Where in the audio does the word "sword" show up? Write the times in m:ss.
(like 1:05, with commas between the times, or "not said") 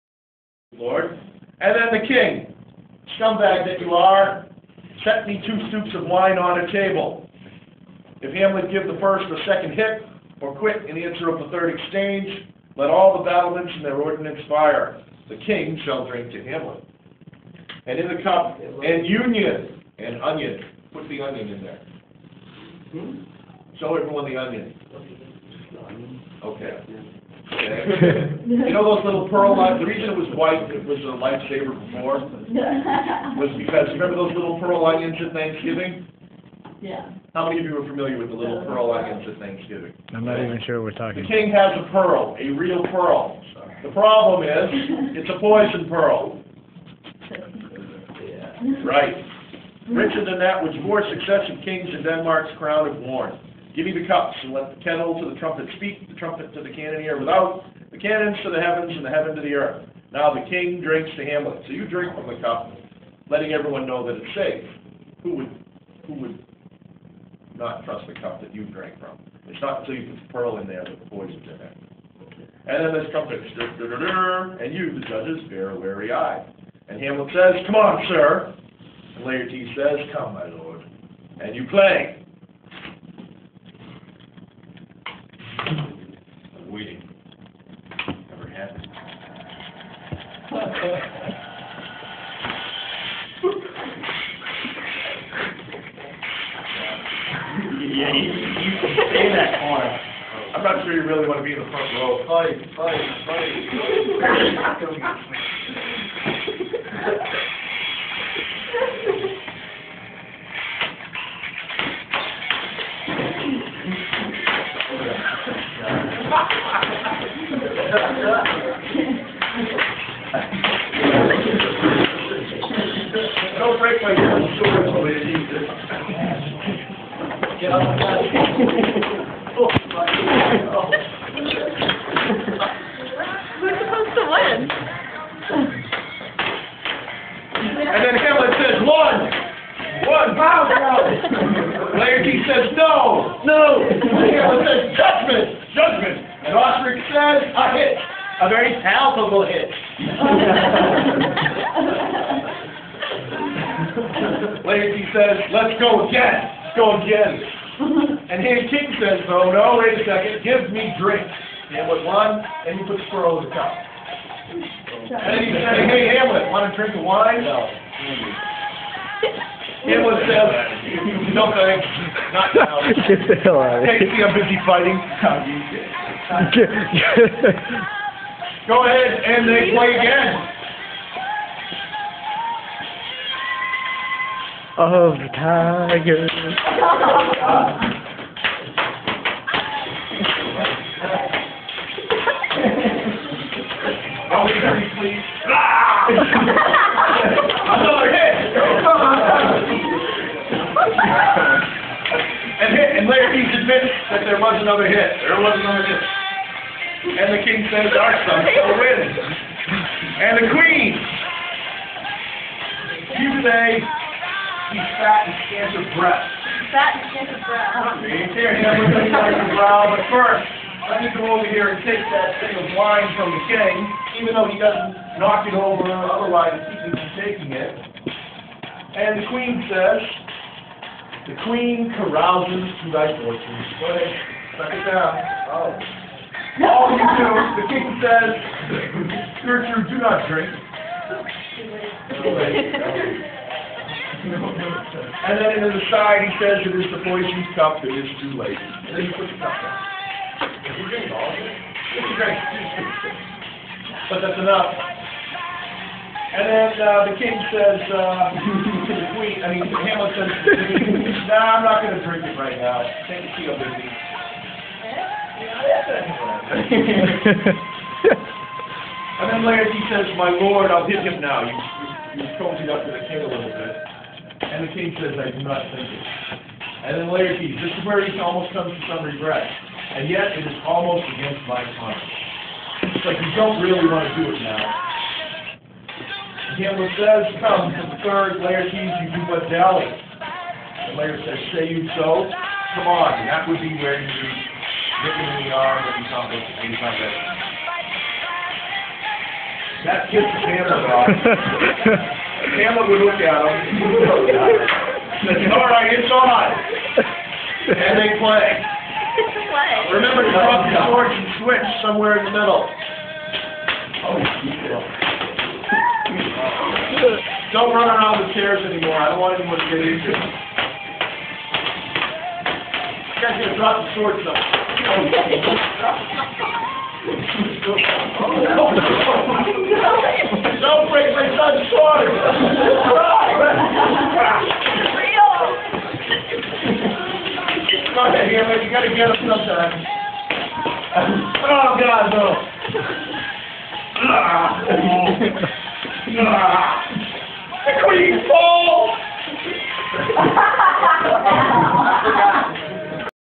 5:23, 5:31.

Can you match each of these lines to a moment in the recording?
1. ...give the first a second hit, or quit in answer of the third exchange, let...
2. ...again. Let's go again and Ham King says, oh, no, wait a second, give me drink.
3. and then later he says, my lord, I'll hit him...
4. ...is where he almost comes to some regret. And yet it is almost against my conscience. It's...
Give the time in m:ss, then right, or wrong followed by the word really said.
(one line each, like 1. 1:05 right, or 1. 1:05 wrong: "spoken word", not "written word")
1. 0:08 right
2. 2:36 right
3. 4:29 right
4. 4:37 right.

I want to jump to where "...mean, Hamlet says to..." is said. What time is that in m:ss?
4:19.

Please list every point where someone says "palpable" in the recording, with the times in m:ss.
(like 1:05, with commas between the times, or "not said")
2:28.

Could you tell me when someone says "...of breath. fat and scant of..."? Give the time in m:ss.
3:35.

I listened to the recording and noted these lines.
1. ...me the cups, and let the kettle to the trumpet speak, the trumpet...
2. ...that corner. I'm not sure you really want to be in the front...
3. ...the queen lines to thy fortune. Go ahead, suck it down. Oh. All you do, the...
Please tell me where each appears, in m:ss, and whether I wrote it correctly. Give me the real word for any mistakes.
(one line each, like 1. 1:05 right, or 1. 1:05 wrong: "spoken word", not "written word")
1. 0:53 right
2. 1:39 right
3. 3:51 wrong: "carouses", not "lines".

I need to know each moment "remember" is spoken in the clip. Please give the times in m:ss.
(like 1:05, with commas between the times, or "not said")
0:33, 5:09.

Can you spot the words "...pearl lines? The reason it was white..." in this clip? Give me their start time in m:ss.
0:29.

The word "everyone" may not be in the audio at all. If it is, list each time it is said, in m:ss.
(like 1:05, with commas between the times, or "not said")
0:23, 1:03.